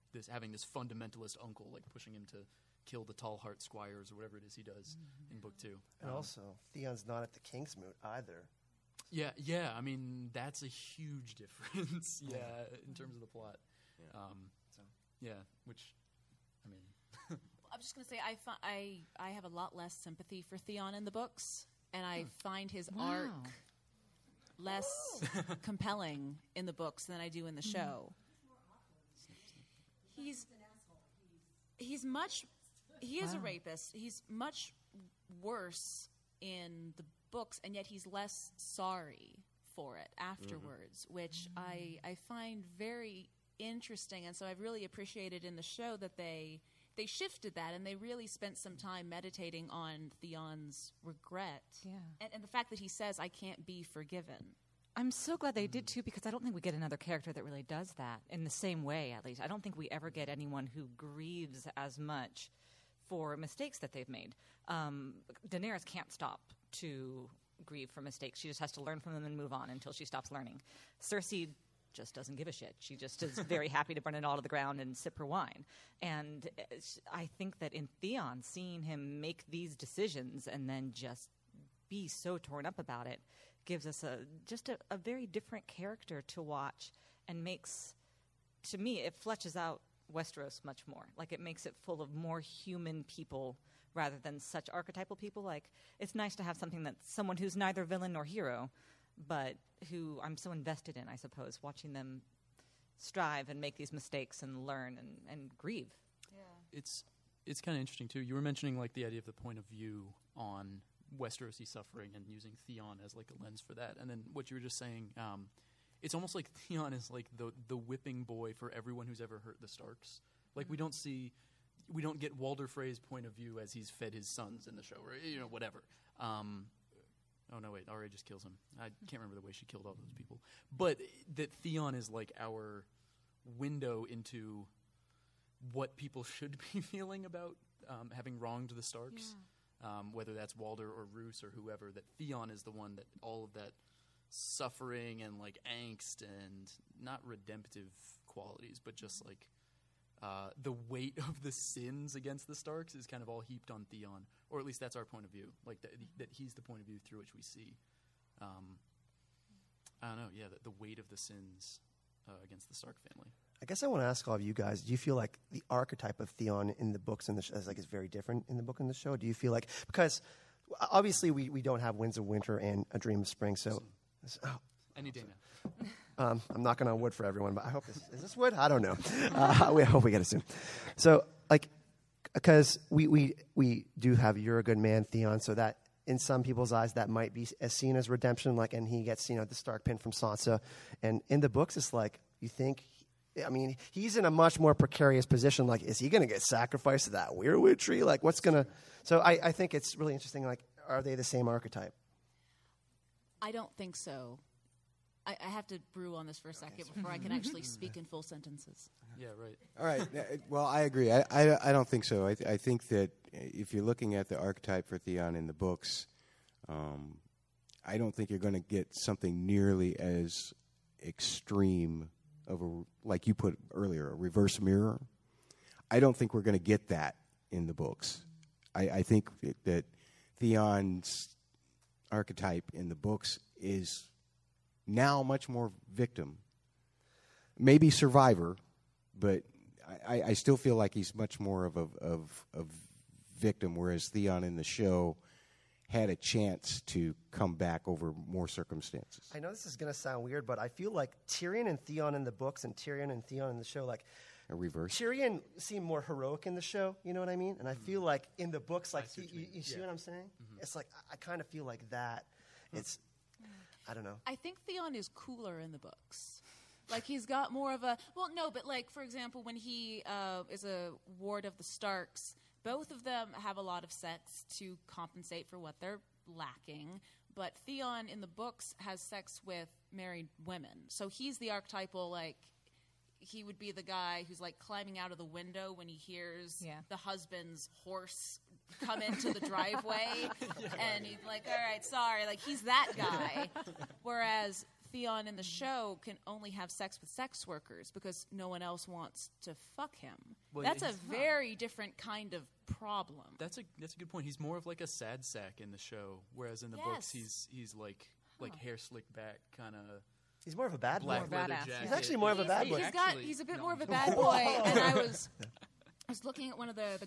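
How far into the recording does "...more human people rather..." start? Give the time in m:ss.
1:32.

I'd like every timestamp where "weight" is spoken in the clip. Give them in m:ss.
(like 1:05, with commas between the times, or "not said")
2:30, 2:40.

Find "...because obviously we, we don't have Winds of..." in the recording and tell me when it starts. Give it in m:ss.
2:49.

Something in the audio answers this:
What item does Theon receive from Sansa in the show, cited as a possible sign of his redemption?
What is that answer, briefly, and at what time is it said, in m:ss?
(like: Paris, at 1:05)
Stark pin, at 3:09.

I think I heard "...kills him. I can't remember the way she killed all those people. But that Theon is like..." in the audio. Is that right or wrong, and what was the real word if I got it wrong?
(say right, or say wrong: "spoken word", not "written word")
right.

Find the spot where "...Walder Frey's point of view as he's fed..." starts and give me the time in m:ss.
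2:02.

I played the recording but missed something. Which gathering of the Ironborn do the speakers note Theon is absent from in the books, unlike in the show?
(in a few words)
King's Moot.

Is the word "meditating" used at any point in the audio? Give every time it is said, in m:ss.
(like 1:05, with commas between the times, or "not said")
0:49.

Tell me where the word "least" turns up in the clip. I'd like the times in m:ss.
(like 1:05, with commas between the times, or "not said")
0:59, 2:34.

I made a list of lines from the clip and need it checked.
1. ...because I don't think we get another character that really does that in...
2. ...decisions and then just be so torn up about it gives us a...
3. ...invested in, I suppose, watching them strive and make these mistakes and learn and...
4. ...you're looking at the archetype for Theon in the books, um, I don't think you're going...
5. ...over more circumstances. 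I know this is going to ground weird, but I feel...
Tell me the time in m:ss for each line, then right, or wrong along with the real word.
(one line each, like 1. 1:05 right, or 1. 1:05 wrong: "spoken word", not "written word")
1. 0:56 right
2. 1:19 right
3. 1:40 right
4. 3:33 right
5. 4:07 wrong: "sound", not "ground".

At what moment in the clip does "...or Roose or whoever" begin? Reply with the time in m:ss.
2:20.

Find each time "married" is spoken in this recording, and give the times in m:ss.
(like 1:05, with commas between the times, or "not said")
4:39.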